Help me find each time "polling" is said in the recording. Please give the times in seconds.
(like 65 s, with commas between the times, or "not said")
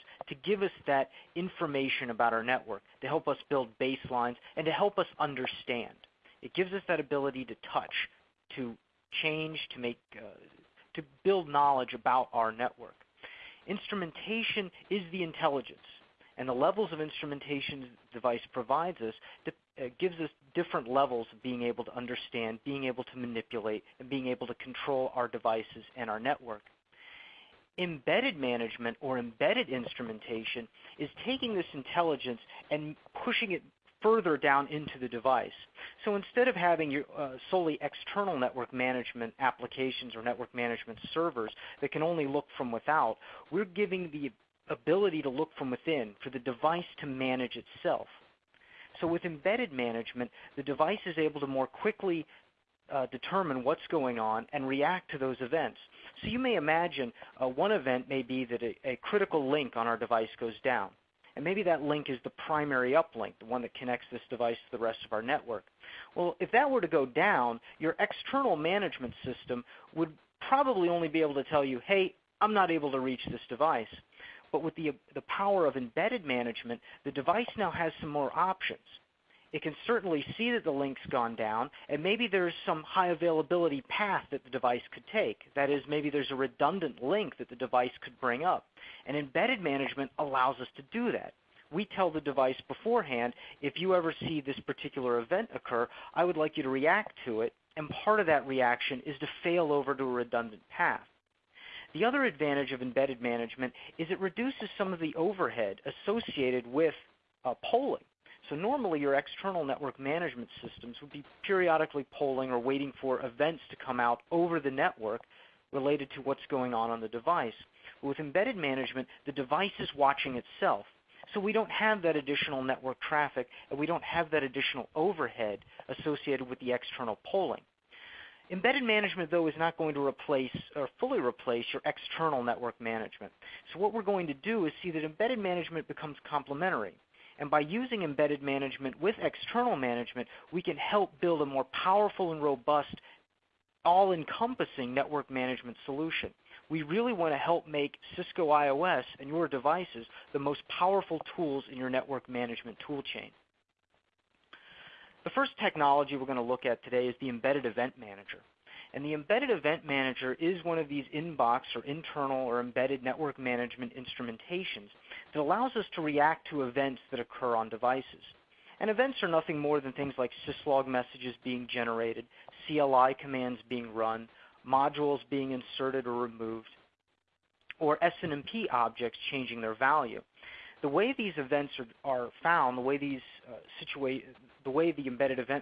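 107 s, 112 s, 127 s.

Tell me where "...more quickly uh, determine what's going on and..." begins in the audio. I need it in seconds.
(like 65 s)
51 s.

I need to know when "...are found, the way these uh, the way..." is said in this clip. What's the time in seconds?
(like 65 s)
182 s.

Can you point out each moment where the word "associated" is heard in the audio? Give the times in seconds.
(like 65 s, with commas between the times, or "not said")
106 s, 125 s.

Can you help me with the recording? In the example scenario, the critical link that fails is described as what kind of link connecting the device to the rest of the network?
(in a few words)
Primary uplink.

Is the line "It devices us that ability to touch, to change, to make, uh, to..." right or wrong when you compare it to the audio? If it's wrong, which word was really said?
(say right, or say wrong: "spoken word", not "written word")
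wrong: "gives", not "devices".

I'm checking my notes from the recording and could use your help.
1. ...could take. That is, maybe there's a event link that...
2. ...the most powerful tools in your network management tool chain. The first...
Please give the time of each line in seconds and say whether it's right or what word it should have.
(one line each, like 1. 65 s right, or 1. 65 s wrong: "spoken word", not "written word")
1. 84 s wrong: "redundant", not "event"
2. 150 s right.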